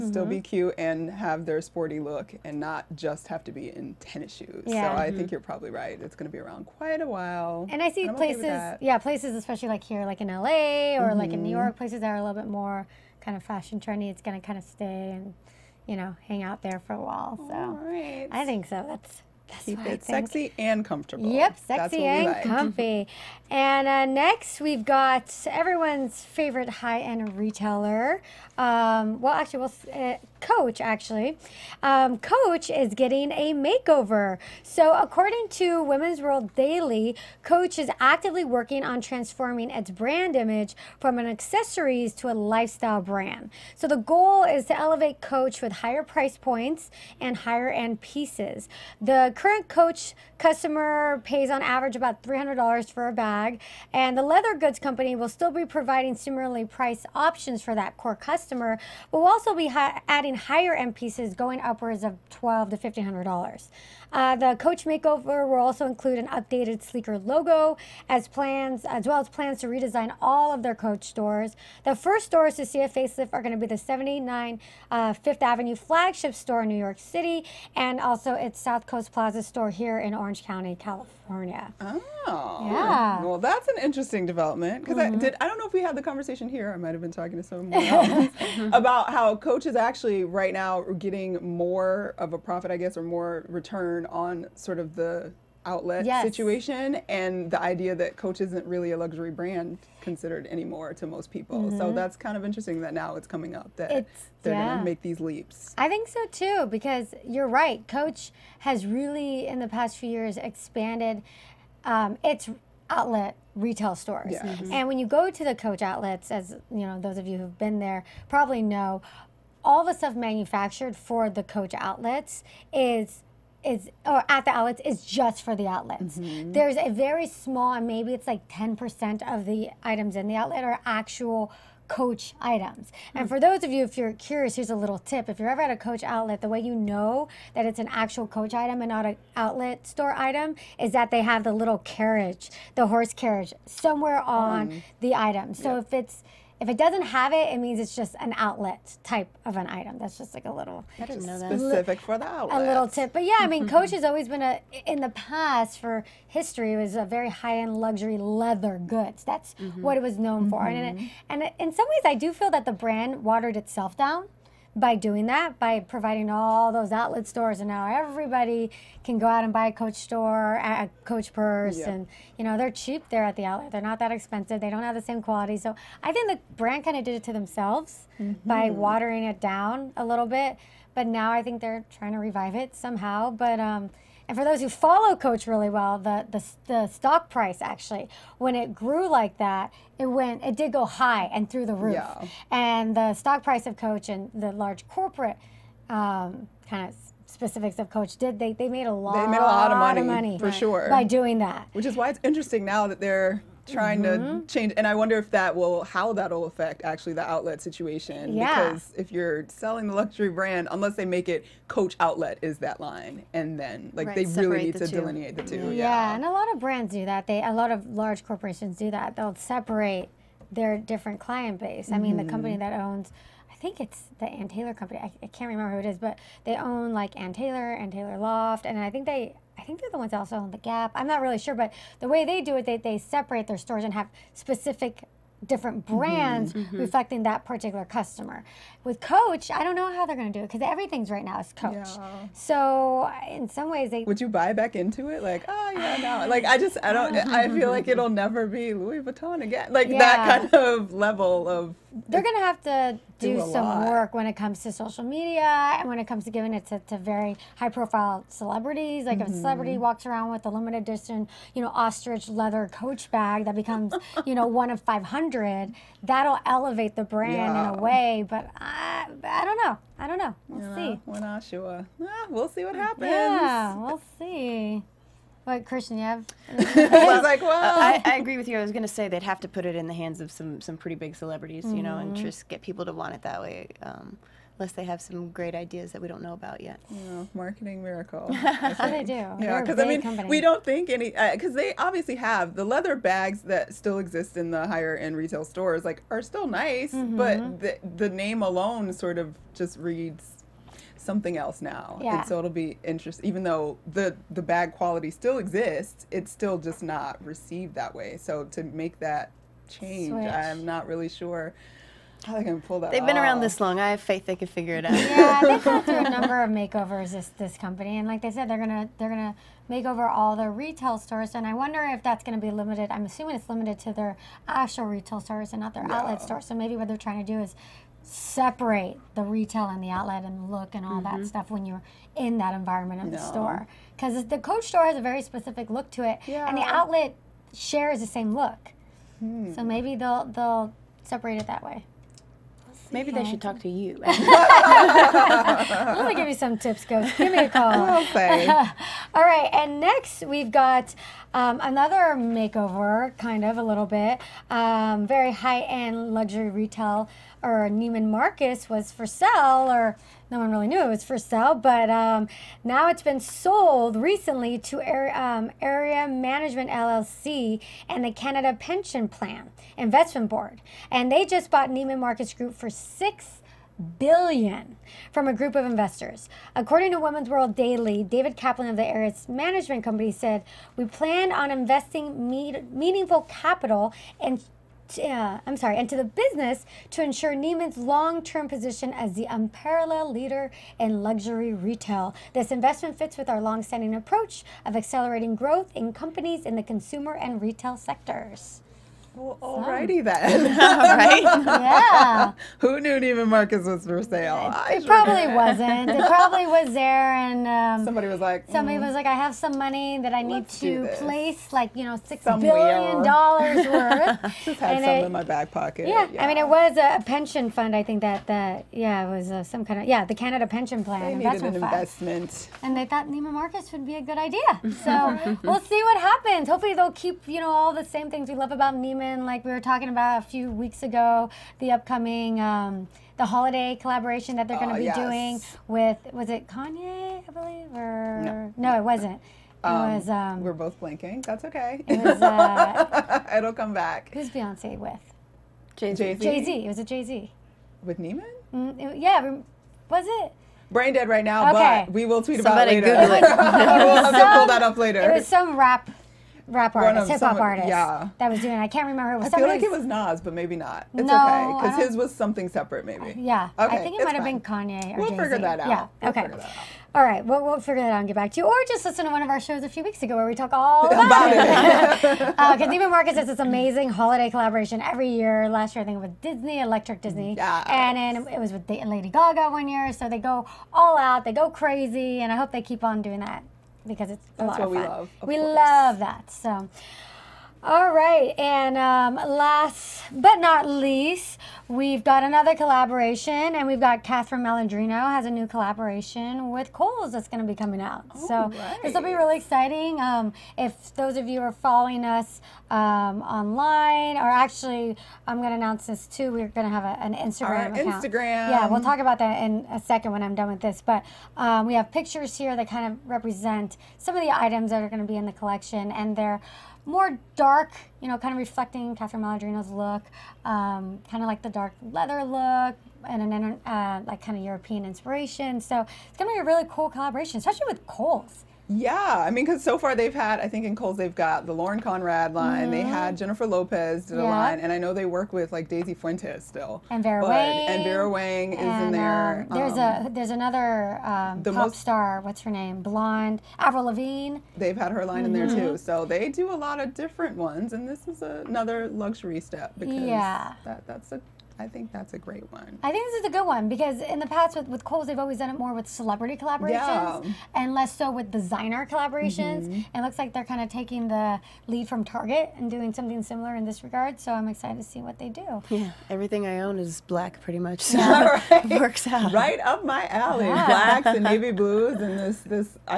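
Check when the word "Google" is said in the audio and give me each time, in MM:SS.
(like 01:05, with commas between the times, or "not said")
07:33.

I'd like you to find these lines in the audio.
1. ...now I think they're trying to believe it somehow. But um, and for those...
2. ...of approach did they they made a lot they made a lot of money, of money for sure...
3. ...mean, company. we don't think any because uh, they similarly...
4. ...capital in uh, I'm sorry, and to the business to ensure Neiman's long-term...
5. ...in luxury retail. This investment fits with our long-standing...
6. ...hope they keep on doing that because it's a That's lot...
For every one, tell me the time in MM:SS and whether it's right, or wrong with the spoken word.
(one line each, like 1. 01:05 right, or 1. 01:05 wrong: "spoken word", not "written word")
1. 03:01 wrong: "revive", not "believe"
2. 03:17 wrong: "coach", not "approach"
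3. 04:49 wrong: "obviously", not "similarly"
4. 06:23 right
5. 06:30 right
6. 08:02 right.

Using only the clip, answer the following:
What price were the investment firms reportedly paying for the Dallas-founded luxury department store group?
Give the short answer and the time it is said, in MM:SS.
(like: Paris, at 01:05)
6 billion, at 06:12.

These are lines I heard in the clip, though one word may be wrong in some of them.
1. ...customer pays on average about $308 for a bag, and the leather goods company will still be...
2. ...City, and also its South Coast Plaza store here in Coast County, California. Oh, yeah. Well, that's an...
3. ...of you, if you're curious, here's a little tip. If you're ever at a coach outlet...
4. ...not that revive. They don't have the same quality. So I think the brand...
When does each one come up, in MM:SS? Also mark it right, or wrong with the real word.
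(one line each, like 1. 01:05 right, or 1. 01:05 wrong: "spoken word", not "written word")
1. 00:50 wrong: "300", not "308"
2. 01:16 wrong: "Orange", not "Coast"
3. 02:13 right
4. 02:53 wrong: "expensive", not "revive".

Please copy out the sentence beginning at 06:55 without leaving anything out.
Yeah, yeah, I mean, it was a, pension fund.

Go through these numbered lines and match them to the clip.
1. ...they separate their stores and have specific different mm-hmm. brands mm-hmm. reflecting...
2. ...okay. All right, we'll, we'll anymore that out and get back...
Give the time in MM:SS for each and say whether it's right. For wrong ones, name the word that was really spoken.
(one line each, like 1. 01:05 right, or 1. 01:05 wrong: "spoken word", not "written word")
1. 03:52 right
2. 07:46 wrong: "figure", not "anymore".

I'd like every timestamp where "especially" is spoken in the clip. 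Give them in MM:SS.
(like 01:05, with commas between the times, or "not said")
00:09, 08:47.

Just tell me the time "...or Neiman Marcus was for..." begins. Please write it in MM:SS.
05:57.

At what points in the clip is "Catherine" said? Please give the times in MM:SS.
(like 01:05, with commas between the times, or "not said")
08:14, 08:38.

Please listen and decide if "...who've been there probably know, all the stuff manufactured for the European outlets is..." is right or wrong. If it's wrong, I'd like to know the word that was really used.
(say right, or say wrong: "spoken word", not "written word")
wrong: "Coach", not "European".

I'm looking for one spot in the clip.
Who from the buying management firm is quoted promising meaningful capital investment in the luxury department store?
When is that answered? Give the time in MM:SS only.
06:18.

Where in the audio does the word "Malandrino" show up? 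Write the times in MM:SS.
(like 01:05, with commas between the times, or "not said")
08:14, 08:39.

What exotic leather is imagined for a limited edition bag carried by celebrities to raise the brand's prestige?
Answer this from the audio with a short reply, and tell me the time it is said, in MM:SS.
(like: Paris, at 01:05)
ostrich, at 04:21.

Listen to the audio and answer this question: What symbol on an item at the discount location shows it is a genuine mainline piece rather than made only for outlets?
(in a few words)
horse carriage.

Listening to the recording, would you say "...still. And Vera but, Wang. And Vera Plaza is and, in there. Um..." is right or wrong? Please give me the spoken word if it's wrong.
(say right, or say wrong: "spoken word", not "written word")
wrong: "Wang", not "Plaza".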